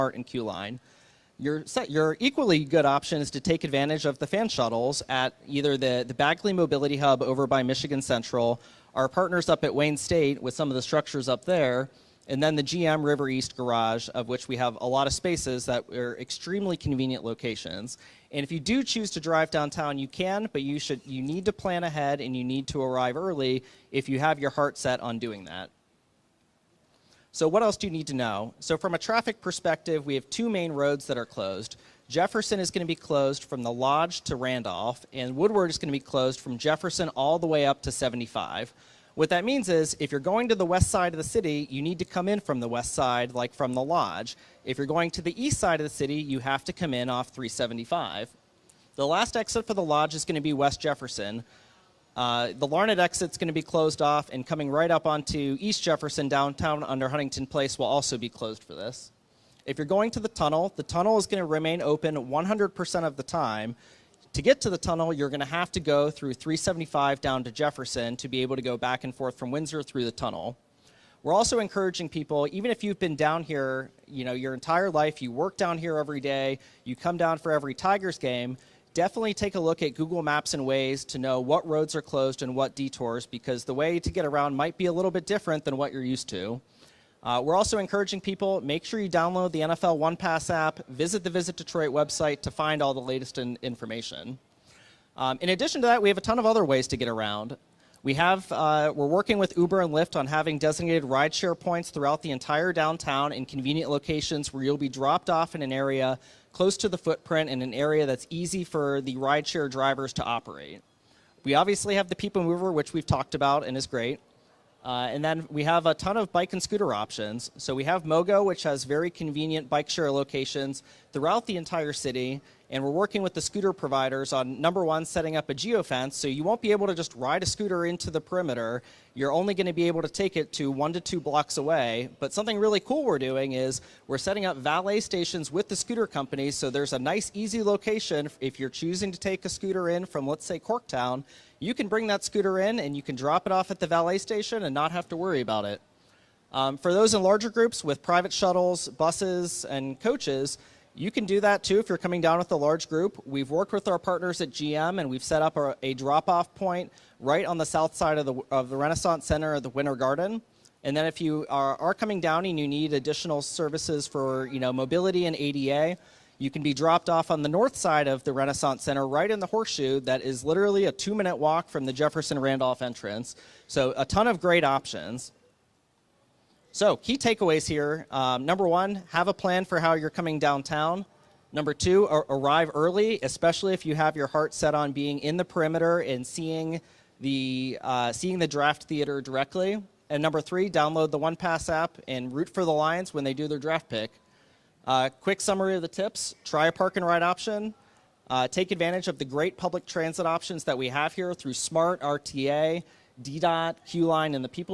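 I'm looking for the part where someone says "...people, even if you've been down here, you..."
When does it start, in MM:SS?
01:12.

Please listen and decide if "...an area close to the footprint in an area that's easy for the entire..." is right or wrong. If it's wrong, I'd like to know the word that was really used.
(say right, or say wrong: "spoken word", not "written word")
wrong: "rideshare", not "entire".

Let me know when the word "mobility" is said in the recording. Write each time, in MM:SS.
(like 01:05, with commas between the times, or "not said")
00:06, 02:44.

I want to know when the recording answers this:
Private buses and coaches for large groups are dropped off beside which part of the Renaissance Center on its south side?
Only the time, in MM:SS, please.
02:39.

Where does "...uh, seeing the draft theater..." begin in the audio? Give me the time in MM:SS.
03:07.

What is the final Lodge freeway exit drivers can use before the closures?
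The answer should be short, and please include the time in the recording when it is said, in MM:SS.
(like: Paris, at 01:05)
West Jefferson, at 00:50.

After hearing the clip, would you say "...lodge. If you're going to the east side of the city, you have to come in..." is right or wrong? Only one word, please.
right.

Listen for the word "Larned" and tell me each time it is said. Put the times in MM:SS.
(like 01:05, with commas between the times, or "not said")
00:52.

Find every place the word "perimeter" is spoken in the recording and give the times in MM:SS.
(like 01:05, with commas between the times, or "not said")
02:08, 03:05.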